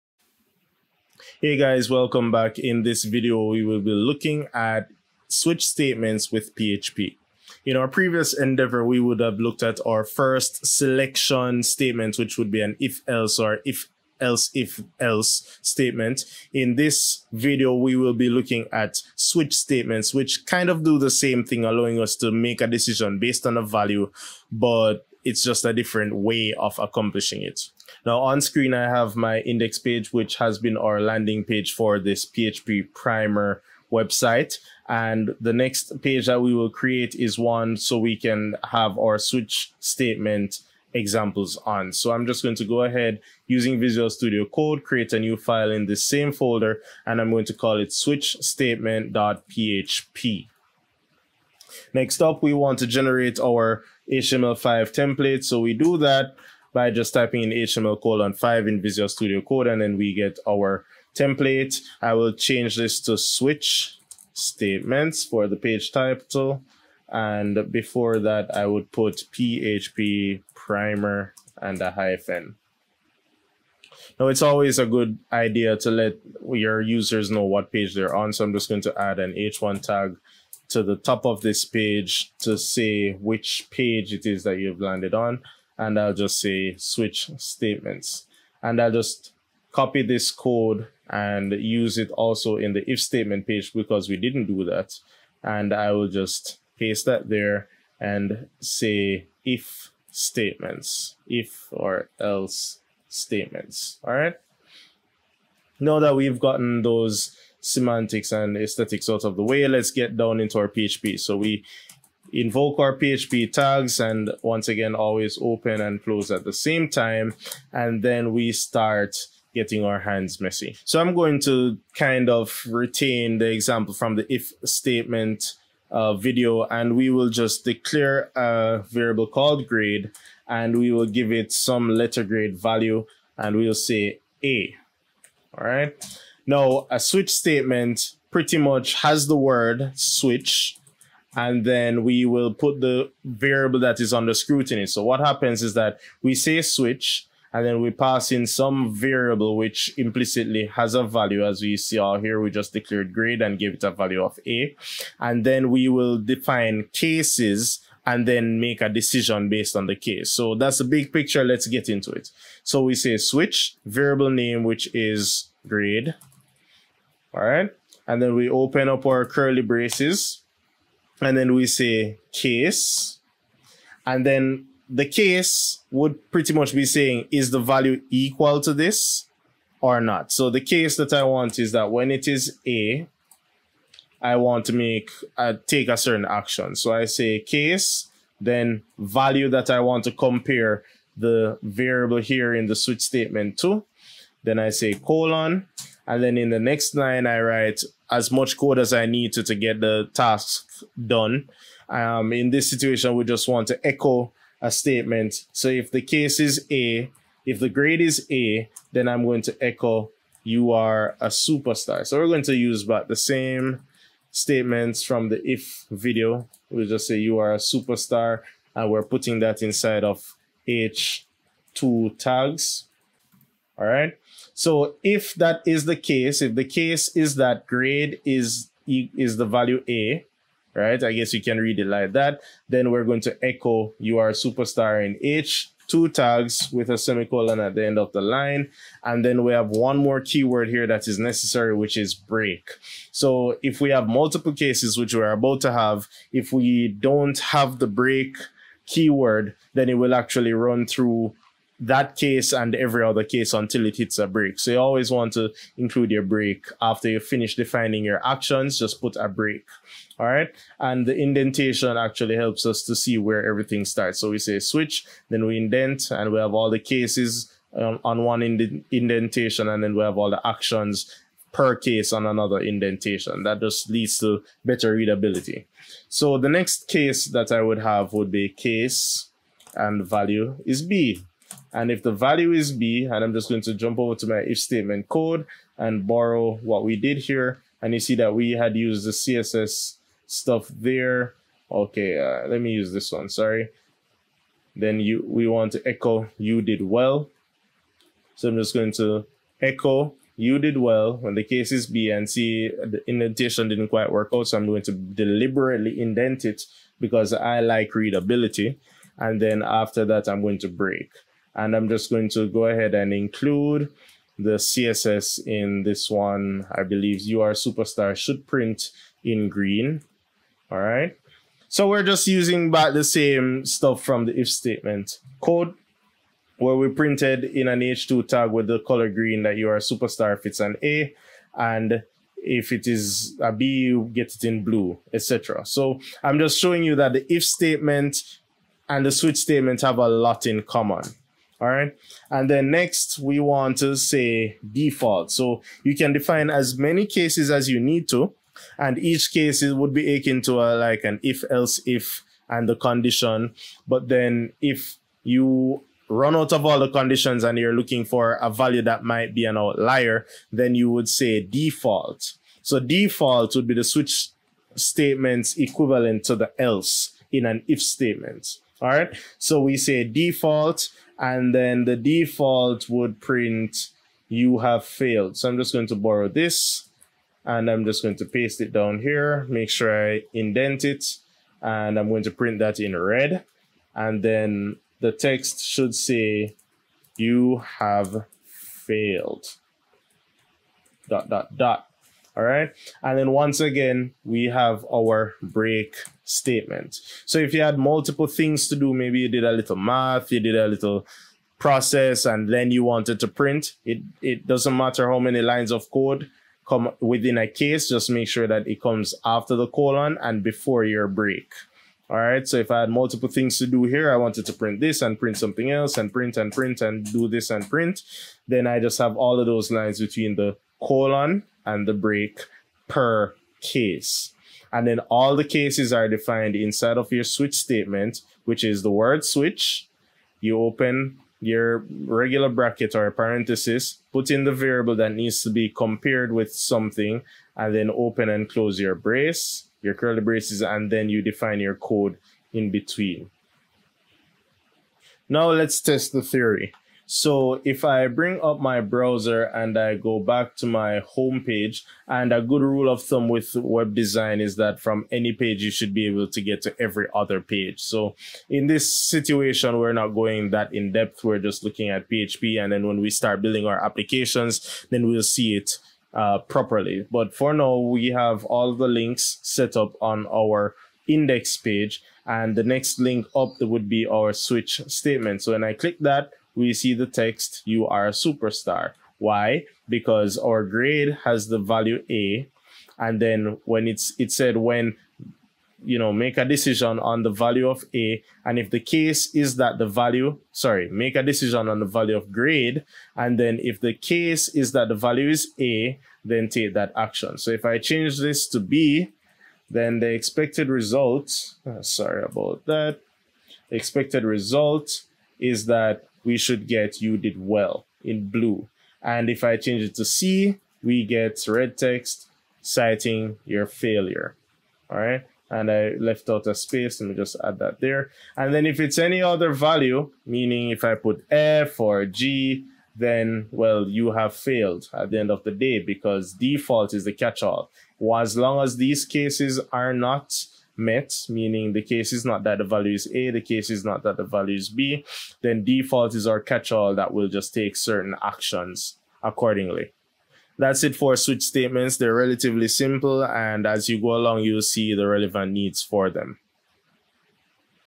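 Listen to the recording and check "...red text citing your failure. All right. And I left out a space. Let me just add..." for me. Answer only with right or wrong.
right.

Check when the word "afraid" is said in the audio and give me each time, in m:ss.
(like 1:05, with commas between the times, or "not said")
not said.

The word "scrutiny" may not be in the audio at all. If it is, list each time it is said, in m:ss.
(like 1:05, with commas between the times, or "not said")
2:24.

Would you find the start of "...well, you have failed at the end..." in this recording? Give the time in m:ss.
8:43.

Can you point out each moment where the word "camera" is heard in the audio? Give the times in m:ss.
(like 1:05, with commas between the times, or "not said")
not said.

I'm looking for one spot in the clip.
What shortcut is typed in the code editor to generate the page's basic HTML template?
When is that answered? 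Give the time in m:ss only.
0:57.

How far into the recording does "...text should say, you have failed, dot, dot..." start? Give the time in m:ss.
6:25.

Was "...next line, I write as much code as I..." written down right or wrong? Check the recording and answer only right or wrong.
right.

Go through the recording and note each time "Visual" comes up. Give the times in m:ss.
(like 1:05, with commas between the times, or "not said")
0:43, 0:58.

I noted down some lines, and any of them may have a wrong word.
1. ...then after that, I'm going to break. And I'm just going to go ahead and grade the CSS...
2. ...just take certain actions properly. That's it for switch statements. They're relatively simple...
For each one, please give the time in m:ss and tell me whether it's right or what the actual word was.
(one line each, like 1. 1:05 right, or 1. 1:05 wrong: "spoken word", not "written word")
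1. 5:09 wrong: "include", not "grade"
2. 8:57 wrong: "accordingly", not "properly".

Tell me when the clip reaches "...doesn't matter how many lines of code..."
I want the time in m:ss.
6:44.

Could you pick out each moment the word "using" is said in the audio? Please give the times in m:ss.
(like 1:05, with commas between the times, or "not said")
0:43, 5:22.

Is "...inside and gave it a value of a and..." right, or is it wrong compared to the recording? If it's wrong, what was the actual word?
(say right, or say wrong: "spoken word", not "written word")
wrong: "grade", not "inside".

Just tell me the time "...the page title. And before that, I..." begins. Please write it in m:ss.
1:05.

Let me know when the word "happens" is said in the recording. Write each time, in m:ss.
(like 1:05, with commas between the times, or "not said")
2:25.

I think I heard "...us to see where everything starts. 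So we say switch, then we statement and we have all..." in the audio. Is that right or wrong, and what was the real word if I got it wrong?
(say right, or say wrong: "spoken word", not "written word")
wrong: "indent", not "statement".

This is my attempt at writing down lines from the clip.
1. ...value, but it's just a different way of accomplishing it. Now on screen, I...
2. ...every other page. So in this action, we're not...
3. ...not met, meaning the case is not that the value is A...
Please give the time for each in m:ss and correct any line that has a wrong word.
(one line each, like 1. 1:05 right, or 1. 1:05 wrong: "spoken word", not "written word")
1. 0:23 right
2. 7:36 wrong: "situation", not "action"
3. 8:49 right.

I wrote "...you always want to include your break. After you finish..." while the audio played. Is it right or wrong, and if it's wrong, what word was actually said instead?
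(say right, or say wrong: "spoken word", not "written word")
right.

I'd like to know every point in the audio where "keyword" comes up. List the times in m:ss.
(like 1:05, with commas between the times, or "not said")
4:00, 4:08.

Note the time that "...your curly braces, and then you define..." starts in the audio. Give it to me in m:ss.
7:19.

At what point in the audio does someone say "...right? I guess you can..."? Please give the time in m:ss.
3:50.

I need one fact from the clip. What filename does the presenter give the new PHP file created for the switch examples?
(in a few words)
switch statement.php.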